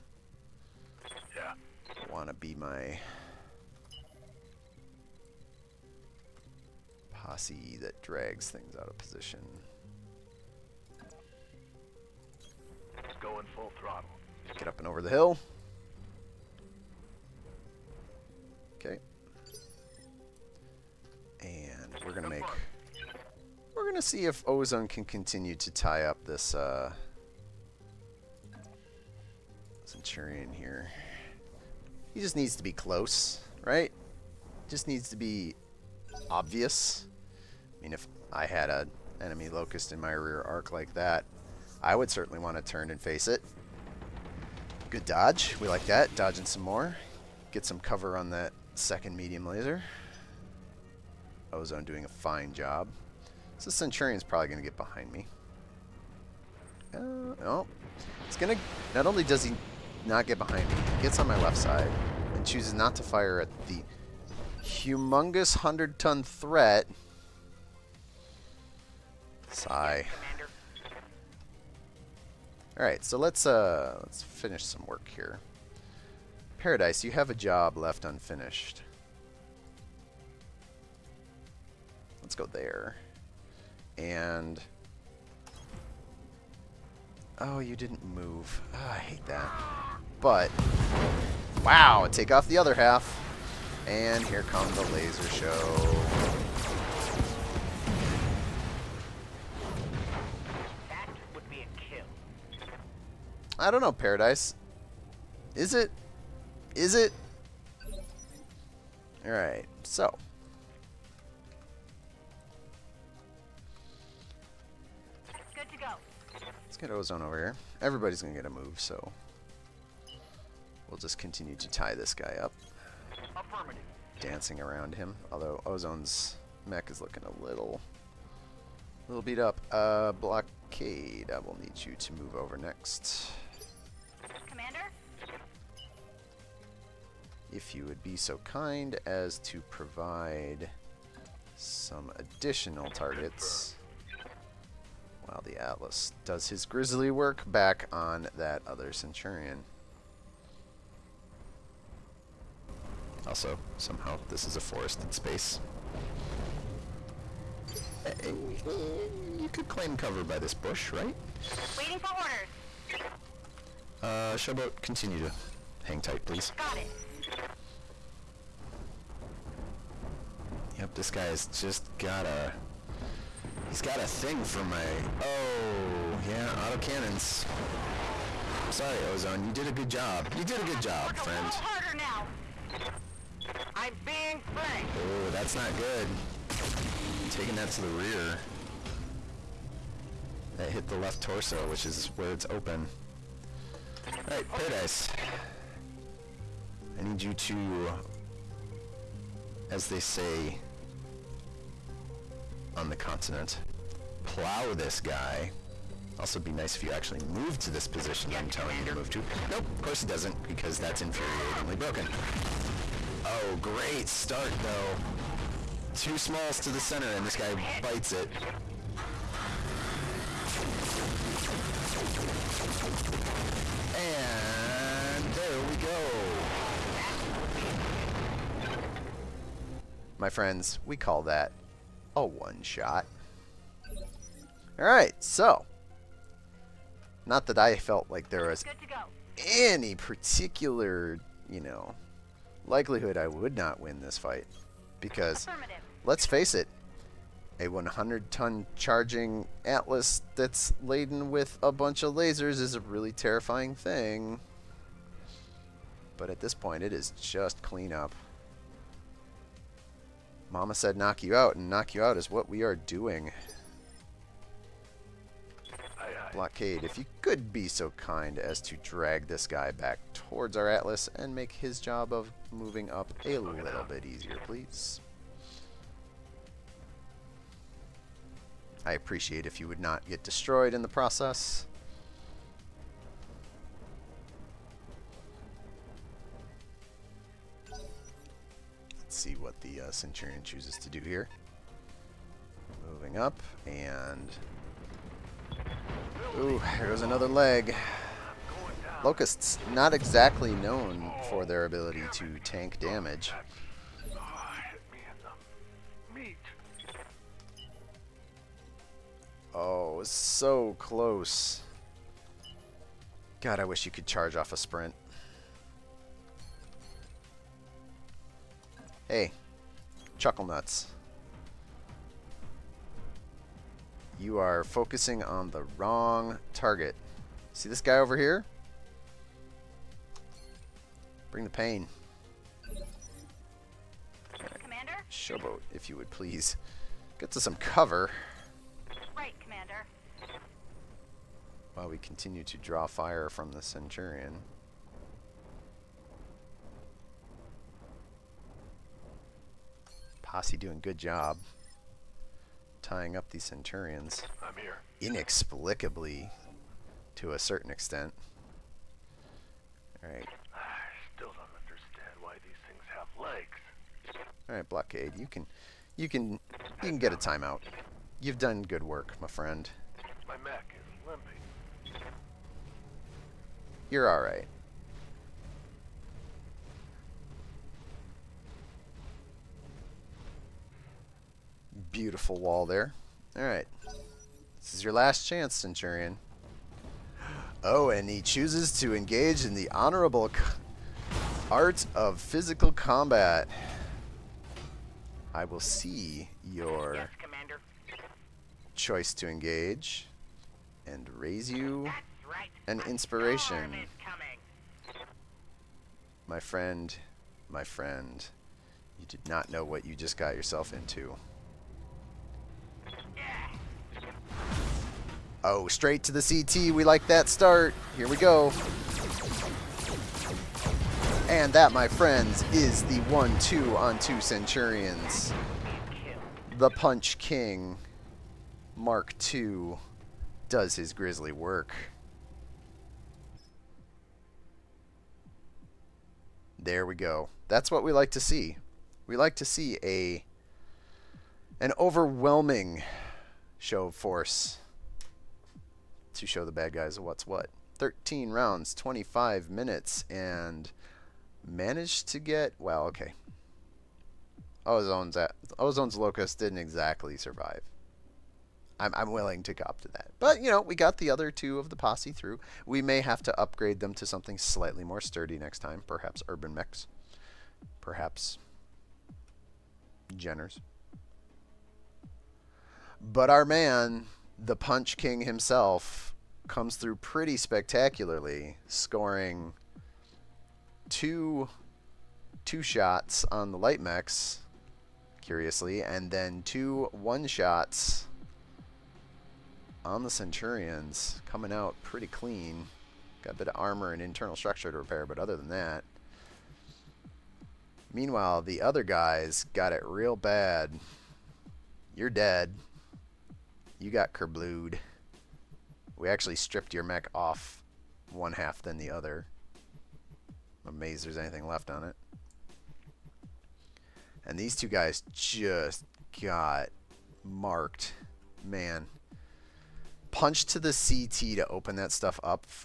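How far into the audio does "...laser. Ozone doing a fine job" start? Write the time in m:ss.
0:49.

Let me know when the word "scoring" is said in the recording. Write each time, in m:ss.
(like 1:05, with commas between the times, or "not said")
7:58.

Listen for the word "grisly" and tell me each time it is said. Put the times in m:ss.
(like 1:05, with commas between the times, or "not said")
2:26, 7:10.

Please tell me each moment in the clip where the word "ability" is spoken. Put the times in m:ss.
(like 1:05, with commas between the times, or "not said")
5:01.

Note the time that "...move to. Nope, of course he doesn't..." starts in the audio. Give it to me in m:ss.
3:28.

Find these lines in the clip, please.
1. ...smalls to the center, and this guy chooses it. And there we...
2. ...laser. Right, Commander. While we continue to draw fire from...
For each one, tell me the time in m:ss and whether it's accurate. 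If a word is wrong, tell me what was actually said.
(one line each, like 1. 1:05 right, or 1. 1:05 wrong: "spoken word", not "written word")
1. 3:36 wrong: "bites", not "chooses"
2. 5:37 wrong: "cover", not "laser".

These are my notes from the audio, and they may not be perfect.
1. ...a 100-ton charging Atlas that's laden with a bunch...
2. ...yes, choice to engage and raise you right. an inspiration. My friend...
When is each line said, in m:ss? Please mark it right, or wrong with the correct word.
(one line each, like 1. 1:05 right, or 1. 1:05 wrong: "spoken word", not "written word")
1. 4:07 right
2. 6:36 right.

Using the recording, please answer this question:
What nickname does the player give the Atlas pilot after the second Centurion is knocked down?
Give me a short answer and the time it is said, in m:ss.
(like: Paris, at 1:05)
The Punch King, Mark II, at 7:06.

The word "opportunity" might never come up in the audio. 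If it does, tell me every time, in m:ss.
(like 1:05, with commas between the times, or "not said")
not said.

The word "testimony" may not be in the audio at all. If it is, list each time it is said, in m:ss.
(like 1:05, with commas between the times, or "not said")
not said.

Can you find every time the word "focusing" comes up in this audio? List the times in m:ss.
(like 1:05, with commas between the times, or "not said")
5:24.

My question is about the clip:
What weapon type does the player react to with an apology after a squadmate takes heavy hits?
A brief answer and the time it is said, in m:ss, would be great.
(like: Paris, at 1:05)
Autocannons, at 2:56.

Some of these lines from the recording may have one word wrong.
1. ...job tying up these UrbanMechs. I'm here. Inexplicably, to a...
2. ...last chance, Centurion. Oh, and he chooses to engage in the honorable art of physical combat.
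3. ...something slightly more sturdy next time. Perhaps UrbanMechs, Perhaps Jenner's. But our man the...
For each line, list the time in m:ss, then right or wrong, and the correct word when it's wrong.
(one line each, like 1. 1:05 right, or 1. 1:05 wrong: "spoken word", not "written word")
1. 5:50 wrong: "Centurions", not "UrbanMechs"
2. 6:24 right
3. 7:44 right.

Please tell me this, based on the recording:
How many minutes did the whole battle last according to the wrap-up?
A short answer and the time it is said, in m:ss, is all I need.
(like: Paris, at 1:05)
25, at 7:28.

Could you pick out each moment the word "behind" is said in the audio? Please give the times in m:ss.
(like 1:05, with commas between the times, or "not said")
0:54, 1:00.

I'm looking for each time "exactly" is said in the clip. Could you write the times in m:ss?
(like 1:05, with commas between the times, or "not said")
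4:59, 7:36.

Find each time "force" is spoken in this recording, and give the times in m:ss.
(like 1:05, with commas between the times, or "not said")
7:23.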